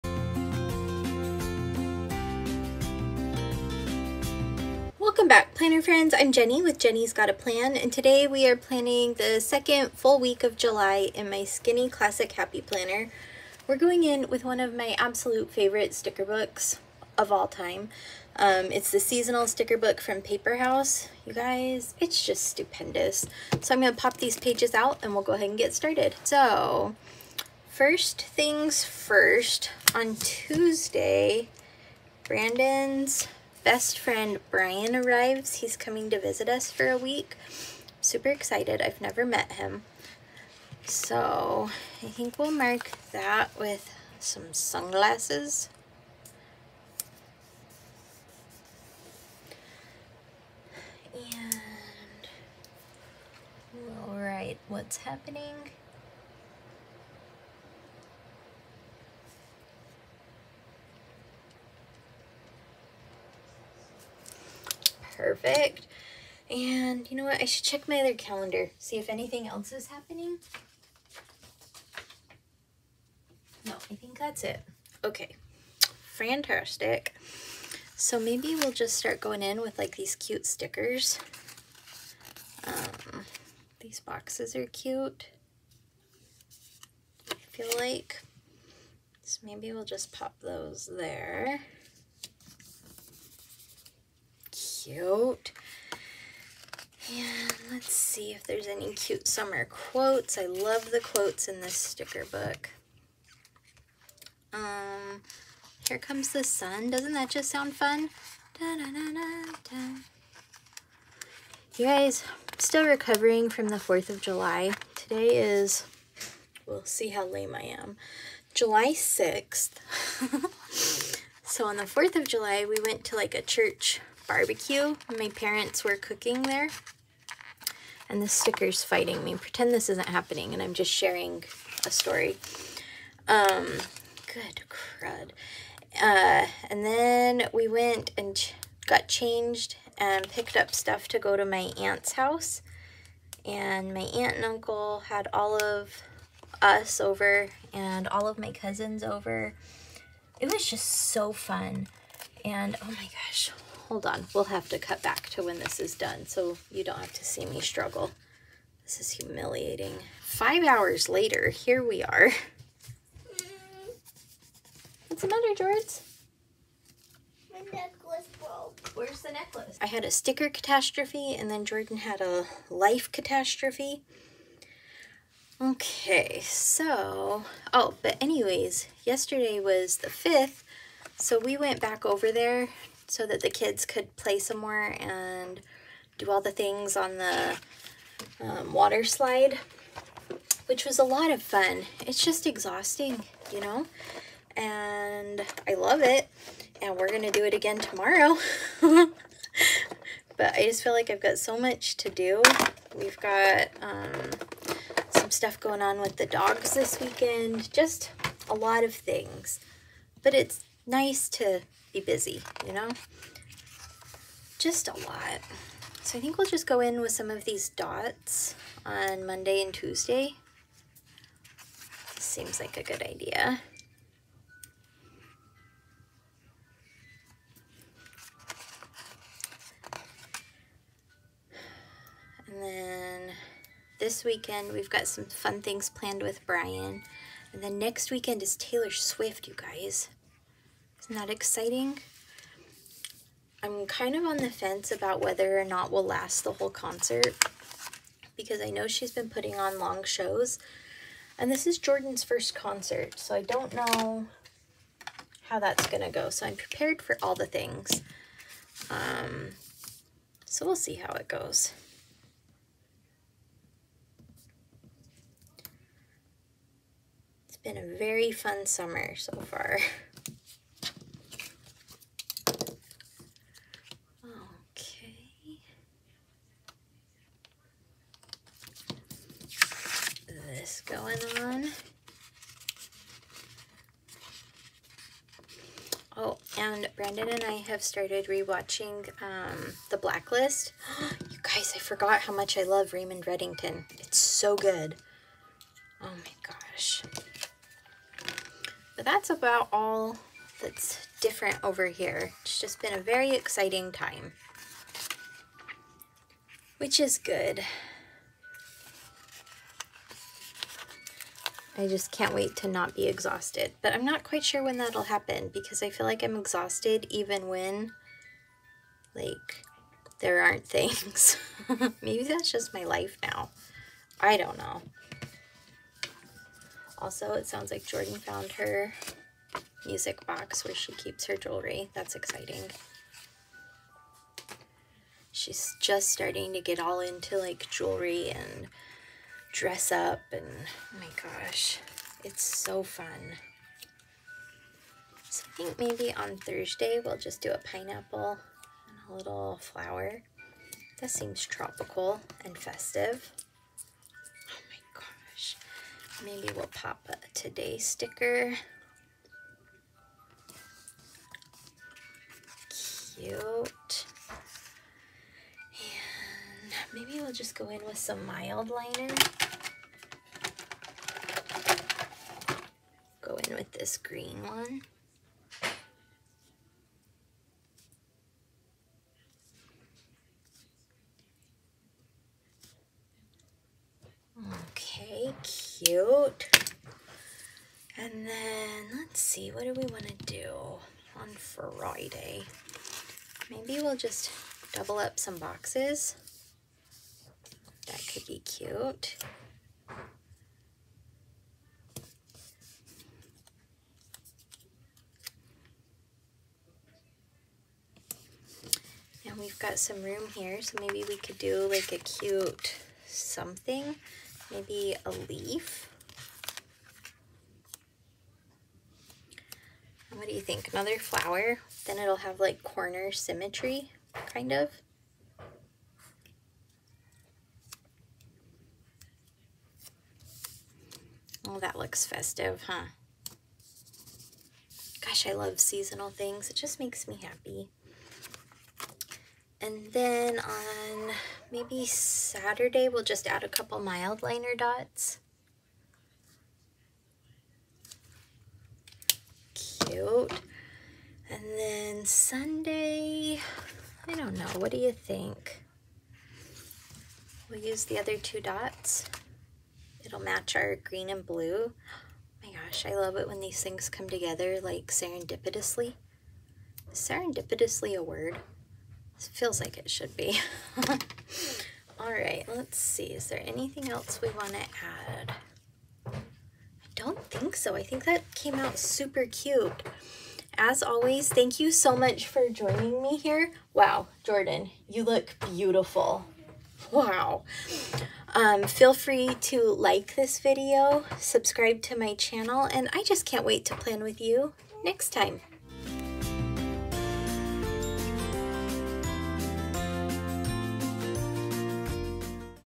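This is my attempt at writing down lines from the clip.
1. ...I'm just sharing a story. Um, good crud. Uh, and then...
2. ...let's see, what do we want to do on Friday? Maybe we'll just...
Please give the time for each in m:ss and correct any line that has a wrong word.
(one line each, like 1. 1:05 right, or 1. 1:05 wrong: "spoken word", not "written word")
1. 2:10 right
2. 6:28 right.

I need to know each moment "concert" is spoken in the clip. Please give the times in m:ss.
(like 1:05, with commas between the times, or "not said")
4:06, 4:12.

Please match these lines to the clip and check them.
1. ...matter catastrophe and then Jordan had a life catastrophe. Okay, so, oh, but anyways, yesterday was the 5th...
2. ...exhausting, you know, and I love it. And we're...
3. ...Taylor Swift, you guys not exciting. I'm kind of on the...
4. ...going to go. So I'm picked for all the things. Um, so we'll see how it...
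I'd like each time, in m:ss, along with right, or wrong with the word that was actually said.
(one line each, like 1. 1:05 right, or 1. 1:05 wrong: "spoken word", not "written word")
1. 2:50 wrong: "sticker", not "matter"
2. 3:12 right
3. 3:58 right
4. 4:15 wrong: "prepared", not "picked".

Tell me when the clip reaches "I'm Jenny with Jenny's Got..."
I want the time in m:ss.
0:06.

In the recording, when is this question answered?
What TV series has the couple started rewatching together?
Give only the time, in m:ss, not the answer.
4:49.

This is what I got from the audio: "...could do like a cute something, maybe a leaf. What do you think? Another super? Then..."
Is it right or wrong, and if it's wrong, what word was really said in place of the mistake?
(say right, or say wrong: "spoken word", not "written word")
wrong: "flower", not "super".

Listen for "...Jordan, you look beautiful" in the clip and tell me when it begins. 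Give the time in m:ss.
8:04.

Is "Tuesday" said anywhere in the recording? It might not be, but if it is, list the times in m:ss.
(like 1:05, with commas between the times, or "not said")
0:30, 3:39.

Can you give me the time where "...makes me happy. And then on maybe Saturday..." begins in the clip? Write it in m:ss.
7:16.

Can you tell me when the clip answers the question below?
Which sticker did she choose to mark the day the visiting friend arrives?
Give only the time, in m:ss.
0:44.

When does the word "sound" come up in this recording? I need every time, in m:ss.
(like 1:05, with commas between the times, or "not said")
1:47, 5:27.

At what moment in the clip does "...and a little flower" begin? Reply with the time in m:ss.
5:49.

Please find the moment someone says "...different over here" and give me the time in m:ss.
5:01.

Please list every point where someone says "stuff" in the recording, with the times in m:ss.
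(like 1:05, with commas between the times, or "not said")
2:20, 3:25.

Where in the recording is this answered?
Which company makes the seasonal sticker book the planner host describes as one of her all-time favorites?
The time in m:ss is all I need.
0:20.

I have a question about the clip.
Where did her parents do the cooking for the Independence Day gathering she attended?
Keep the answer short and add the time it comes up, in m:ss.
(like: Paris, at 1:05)
Church barbecue, at 2:03.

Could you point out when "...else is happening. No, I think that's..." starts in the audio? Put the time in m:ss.
1:09.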